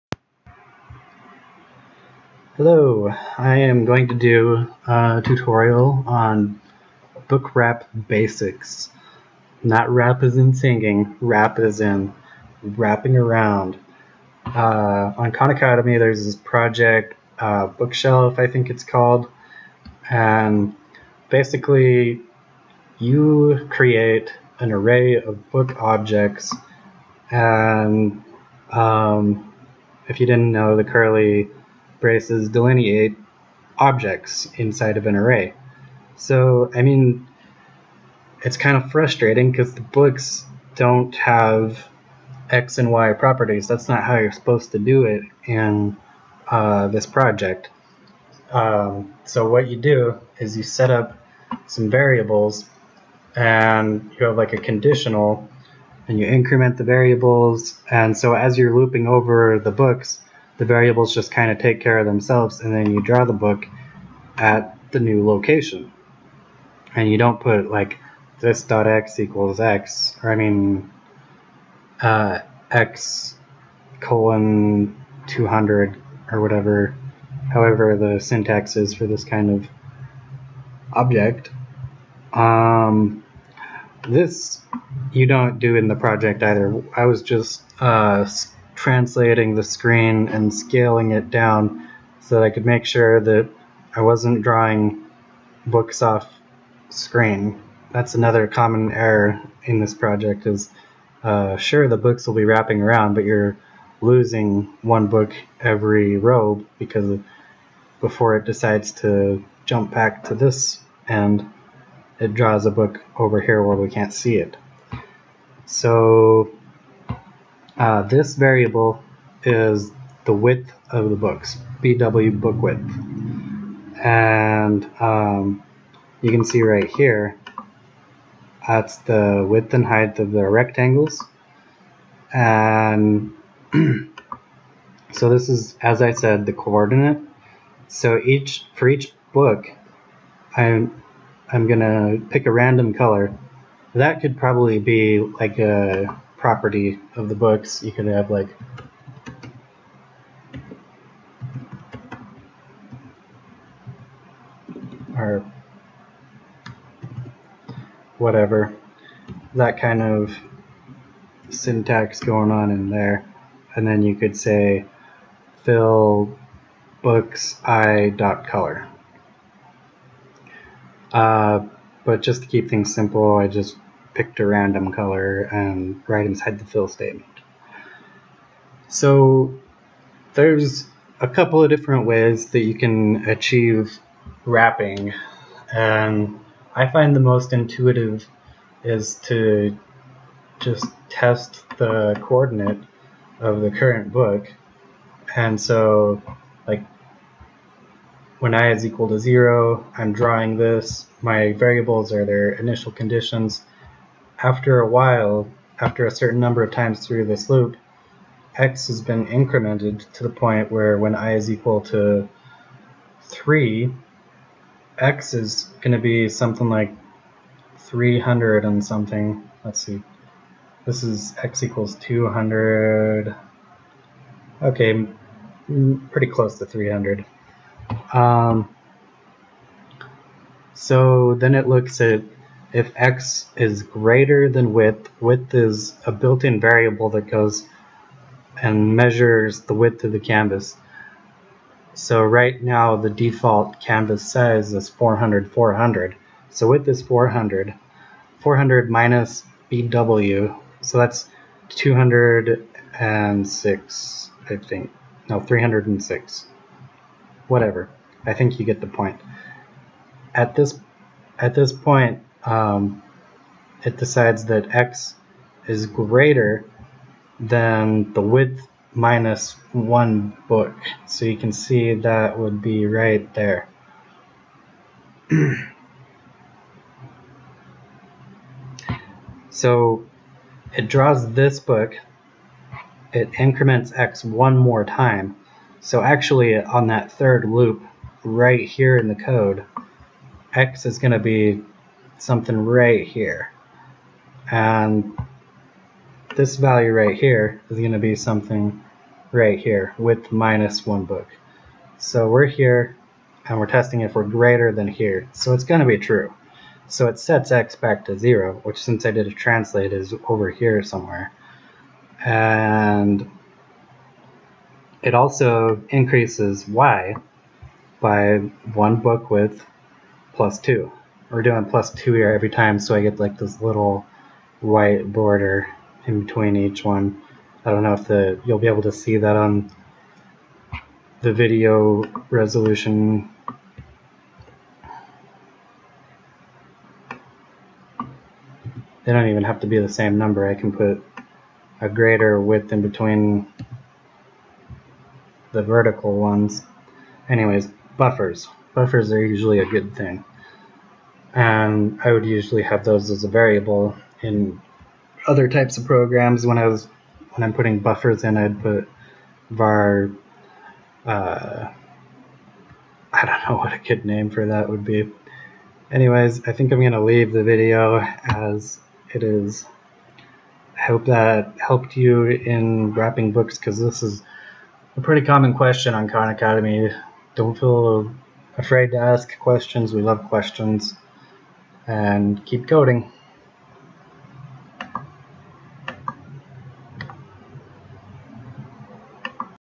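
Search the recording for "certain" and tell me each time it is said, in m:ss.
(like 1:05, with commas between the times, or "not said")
3:26.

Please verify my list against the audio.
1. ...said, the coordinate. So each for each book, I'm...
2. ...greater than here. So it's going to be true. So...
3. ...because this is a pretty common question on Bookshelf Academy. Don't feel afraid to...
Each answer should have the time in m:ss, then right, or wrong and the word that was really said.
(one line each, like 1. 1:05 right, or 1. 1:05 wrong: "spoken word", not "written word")
1. 2:16 right
2. 5:04 right
3. 6:13 wrong: "Khan", not "Bookshelf".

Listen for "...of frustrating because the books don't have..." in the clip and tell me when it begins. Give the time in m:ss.
0:38.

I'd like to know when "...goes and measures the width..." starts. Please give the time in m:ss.
3:57.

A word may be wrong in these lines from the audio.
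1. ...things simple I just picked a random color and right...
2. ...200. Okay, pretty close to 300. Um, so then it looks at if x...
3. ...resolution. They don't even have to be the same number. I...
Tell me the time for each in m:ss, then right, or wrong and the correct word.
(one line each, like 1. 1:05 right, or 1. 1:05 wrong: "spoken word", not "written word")
1. 2:52 right
2. 3:41 right
3. 5:32 right.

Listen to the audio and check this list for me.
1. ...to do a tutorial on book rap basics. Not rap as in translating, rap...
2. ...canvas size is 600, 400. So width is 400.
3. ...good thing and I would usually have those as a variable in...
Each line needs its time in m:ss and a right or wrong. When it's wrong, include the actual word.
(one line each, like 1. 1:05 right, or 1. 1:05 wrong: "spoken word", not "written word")
1. 0:04 wrong: "singing", not "translating"
2. 4:03 wrong: "400", not "600"
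3. 5:49 right.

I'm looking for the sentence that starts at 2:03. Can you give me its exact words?
And um, you can see right here, that's the width and height of the rectangles.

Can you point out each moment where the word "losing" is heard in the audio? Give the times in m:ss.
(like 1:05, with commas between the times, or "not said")
1:44.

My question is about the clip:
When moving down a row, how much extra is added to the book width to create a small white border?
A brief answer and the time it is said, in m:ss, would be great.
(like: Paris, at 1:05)
2, at 5:20.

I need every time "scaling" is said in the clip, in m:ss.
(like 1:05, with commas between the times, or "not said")
1:30.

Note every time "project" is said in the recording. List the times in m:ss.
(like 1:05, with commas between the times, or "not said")
0:16, 0:47, 1:25, 1:39.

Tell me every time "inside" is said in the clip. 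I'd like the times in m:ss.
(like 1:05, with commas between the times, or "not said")
0:34, 2:56.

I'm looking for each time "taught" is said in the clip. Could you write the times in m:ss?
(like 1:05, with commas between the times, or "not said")
not said.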